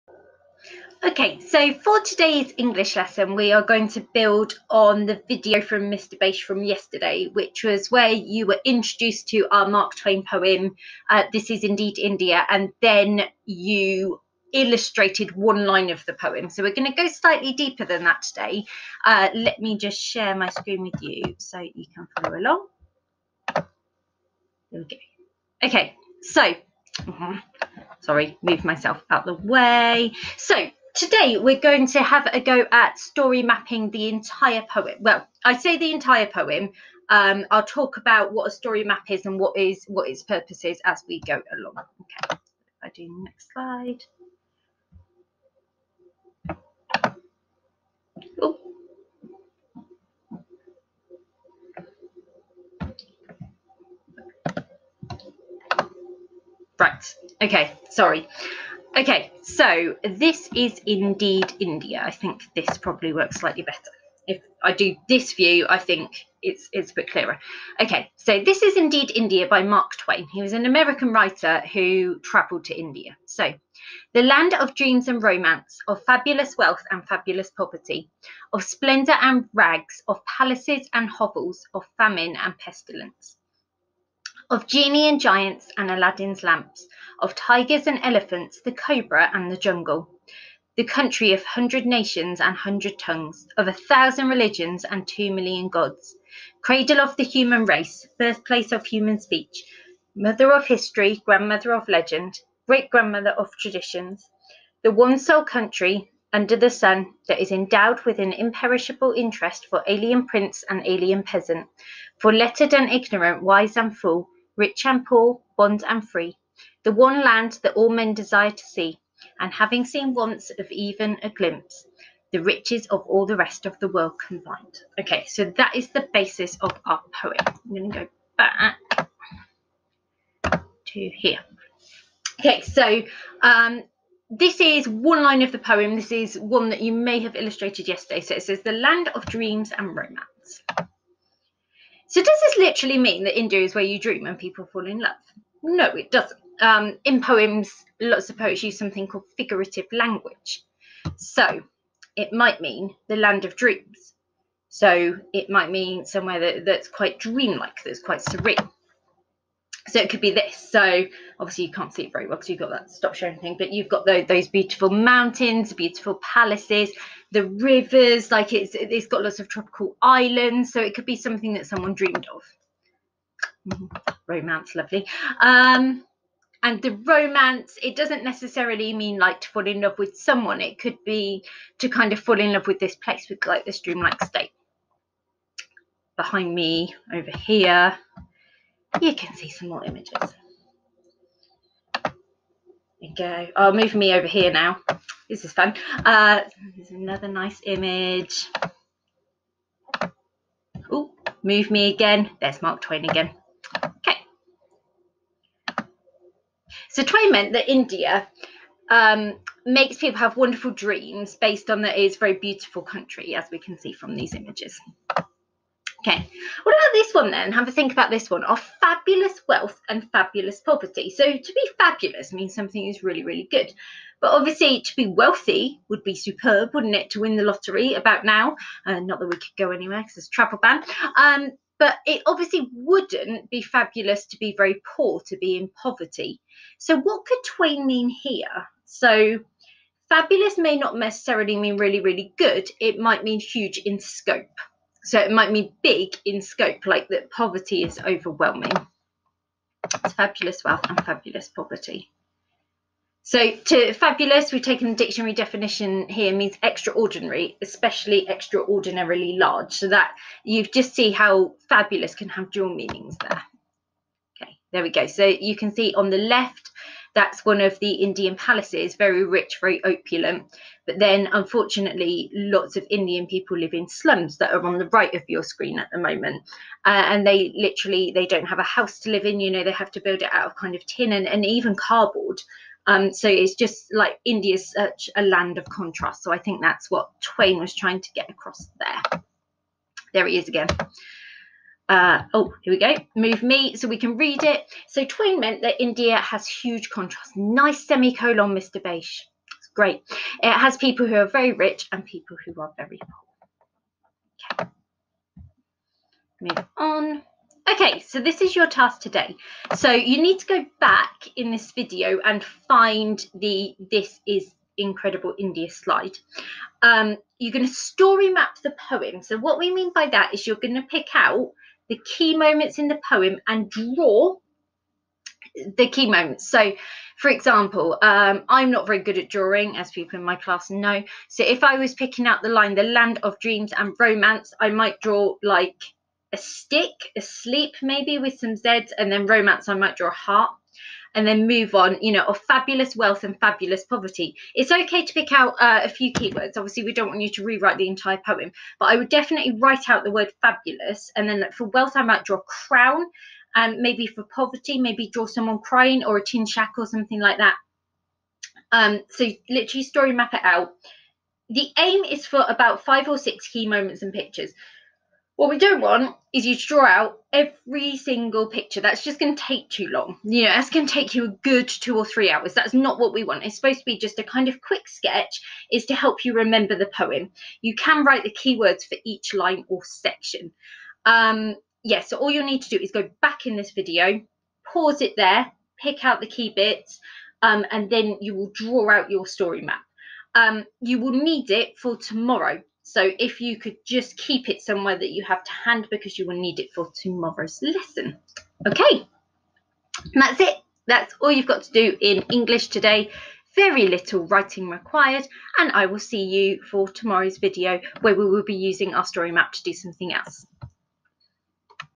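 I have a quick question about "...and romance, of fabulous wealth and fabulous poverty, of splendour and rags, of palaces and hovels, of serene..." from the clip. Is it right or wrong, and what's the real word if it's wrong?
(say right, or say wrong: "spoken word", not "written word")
wrong: "famine", not "serene".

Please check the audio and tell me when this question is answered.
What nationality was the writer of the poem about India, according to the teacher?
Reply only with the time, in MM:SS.
01:10.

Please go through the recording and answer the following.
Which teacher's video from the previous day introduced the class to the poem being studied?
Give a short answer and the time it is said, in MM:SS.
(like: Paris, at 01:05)
Mr. Bache, at 00:05.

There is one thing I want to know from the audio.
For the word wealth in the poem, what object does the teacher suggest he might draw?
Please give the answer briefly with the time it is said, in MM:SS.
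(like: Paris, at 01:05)
crown, at 05:52.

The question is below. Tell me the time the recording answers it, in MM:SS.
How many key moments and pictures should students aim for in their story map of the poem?
06:02.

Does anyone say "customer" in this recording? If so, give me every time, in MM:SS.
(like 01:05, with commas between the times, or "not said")
not said.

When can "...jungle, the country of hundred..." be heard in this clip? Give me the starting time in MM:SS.
01:29.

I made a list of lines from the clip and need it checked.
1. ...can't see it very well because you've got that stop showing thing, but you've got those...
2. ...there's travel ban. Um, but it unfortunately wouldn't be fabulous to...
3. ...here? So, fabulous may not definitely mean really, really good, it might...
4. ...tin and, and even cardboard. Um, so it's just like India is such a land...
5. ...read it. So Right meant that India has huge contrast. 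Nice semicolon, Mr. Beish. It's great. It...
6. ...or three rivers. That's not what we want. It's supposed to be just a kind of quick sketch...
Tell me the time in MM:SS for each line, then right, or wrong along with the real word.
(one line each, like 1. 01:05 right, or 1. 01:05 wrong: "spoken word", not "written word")
1. 02:41 right
2. 03:50 wrong: "obviously", not "unfortunately"
3. 03:58 wrong: "necessarily", not "definitely"
4. 04:40 right
5. 04:54 wrong: "Twain", not "Right"
6. 06:11 wrong: "hours", not "rivers".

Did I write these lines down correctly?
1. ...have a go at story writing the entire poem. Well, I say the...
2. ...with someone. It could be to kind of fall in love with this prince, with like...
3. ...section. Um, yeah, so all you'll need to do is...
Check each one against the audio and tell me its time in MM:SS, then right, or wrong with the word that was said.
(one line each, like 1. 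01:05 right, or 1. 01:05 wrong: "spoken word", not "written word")
1. 00:32 wrong: "mapping", not "writing"
2. 02:59 wrong: "place", not "prince"
3. 06:19 right.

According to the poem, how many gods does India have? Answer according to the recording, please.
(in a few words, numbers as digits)
2 million.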